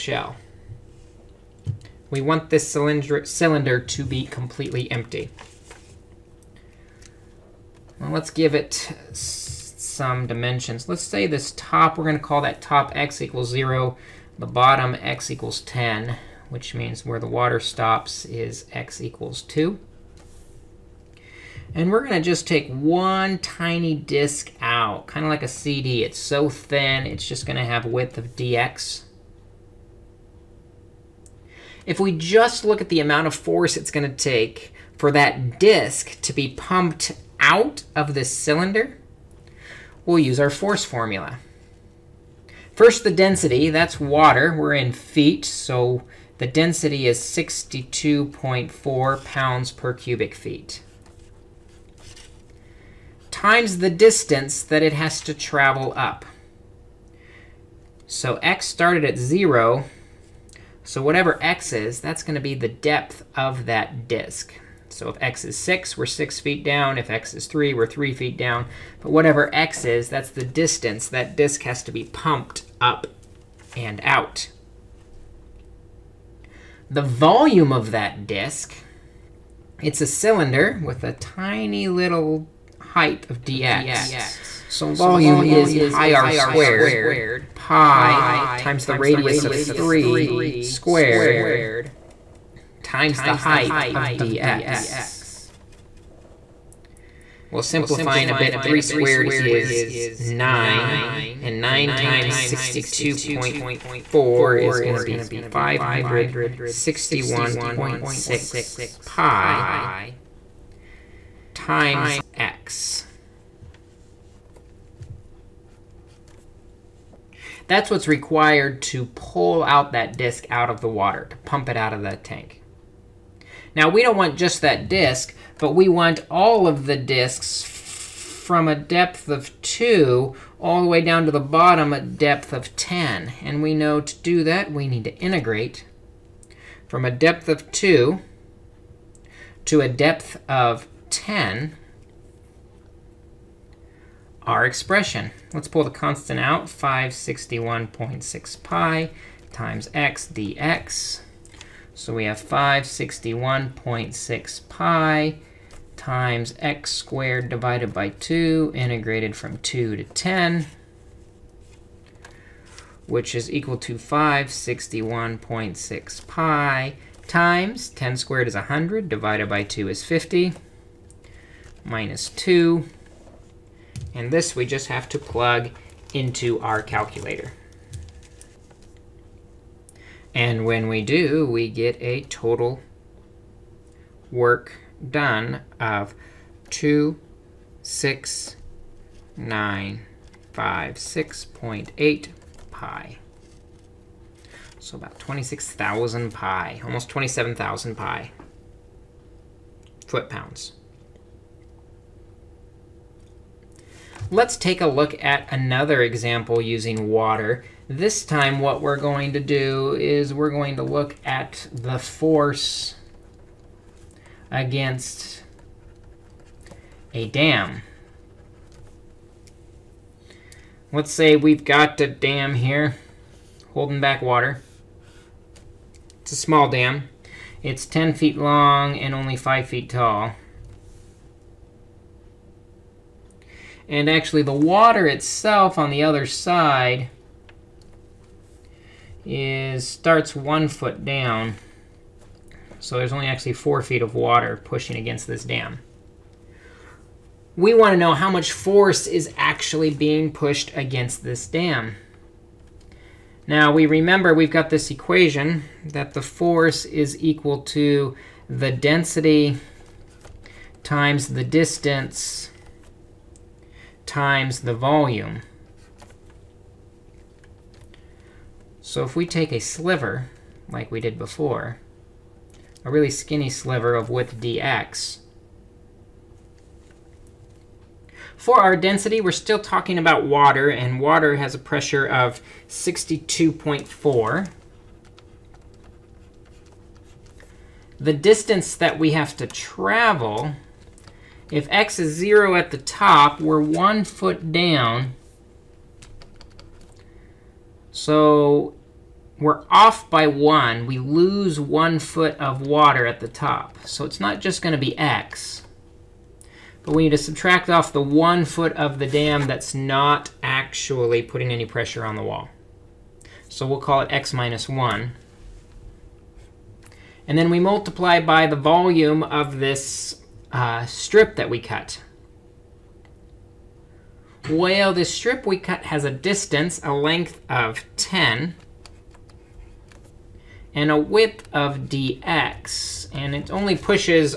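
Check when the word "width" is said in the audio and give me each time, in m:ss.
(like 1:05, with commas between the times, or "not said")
0:27, 4:34, 5:30.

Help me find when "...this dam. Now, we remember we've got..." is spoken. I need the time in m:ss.
4:11.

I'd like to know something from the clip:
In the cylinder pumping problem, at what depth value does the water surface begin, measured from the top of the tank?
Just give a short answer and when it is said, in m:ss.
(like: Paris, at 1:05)
x = 2, at 0:18.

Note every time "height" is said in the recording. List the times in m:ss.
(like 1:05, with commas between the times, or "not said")
1:22, 1:33.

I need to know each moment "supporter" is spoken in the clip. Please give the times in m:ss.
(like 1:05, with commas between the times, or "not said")
not said.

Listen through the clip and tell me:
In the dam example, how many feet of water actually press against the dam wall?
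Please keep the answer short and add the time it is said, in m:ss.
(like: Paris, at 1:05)
4 feet, at 4:03.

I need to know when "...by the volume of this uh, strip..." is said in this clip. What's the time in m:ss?
5:18.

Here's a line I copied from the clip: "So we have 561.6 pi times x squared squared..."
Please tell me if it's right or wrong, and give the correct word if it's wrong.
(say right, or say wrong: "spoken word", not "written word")
wrong: "divided", not "squared".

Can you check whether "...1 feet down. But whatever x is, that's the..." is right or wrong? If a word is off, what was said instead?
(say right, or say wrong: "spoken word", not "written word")
wrong: "3", not "1".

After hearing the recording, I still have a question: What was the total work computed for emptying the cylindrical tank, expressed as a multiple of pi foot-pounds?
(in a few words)
26956.8 pi.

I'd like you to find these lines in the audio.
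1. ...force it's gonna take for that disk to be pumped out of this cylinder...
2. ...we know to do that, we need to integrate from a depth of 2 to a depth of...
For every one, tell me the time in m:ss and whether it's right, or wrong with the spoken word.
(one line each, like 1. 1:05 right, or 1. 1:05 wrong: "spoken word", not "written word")
1. 0:33 right
2. 2:13 right.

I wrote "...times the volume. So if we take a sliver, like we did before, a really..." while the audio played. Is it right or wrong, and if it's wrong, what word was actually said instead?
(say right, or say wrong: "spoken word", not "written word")
right.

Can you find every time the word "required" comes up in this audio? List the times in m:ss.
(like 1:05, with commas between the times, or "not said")
1:58.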